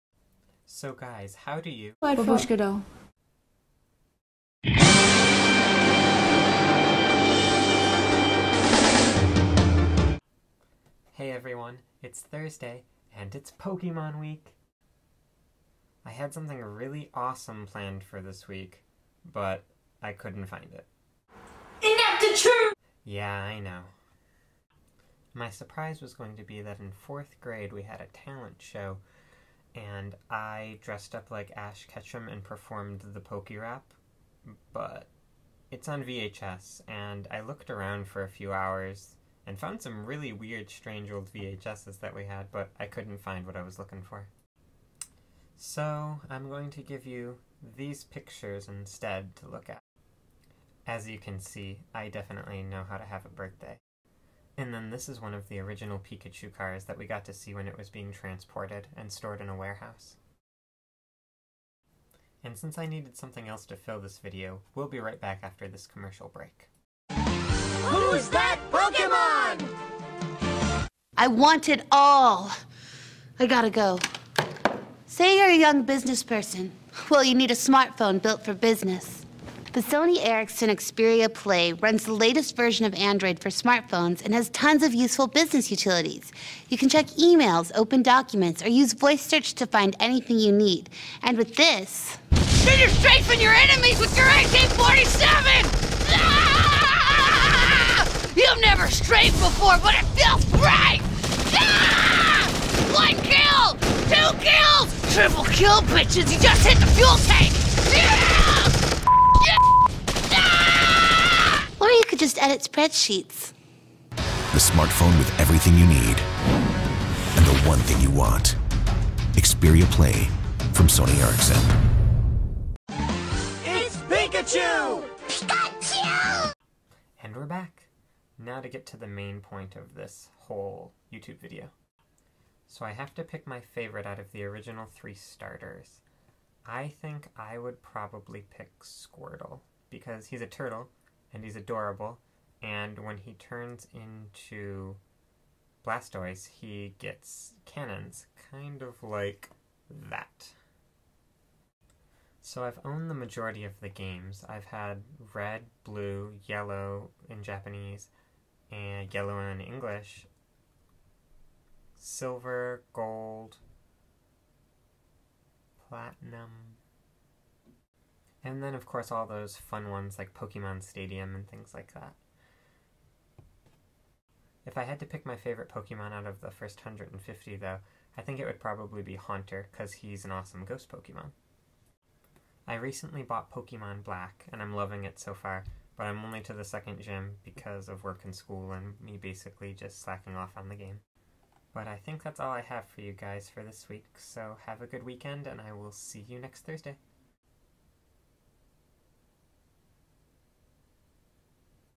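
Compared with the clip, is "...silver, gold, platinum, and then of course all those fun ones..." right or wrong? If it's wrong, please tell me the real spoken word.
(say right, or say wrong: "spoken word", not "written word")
right.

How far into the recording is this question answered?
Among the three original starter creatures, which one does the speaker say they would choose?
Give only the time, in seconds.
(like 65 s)
138 s.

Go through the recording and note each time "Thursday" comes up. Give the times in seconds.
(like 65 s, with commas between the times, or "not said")
12 s, 196 s.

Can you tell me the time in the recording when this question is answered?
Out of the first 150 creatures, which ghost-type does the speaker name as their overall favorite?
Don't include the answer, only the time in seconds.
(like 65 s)
179 s.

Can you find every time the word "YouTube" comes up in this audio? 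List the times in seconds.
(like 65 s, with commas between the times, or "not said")
131 s.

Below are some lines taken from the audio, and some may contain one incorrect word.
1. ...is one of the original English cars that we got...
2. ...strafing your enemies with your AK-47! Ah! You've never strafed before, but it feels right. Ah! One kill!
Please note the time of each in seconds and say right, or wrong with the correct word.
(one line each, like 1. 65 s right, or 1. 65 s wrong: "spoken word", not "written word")
1. 55 s wrong: "Pikachu", not "English"
2. 92 s right.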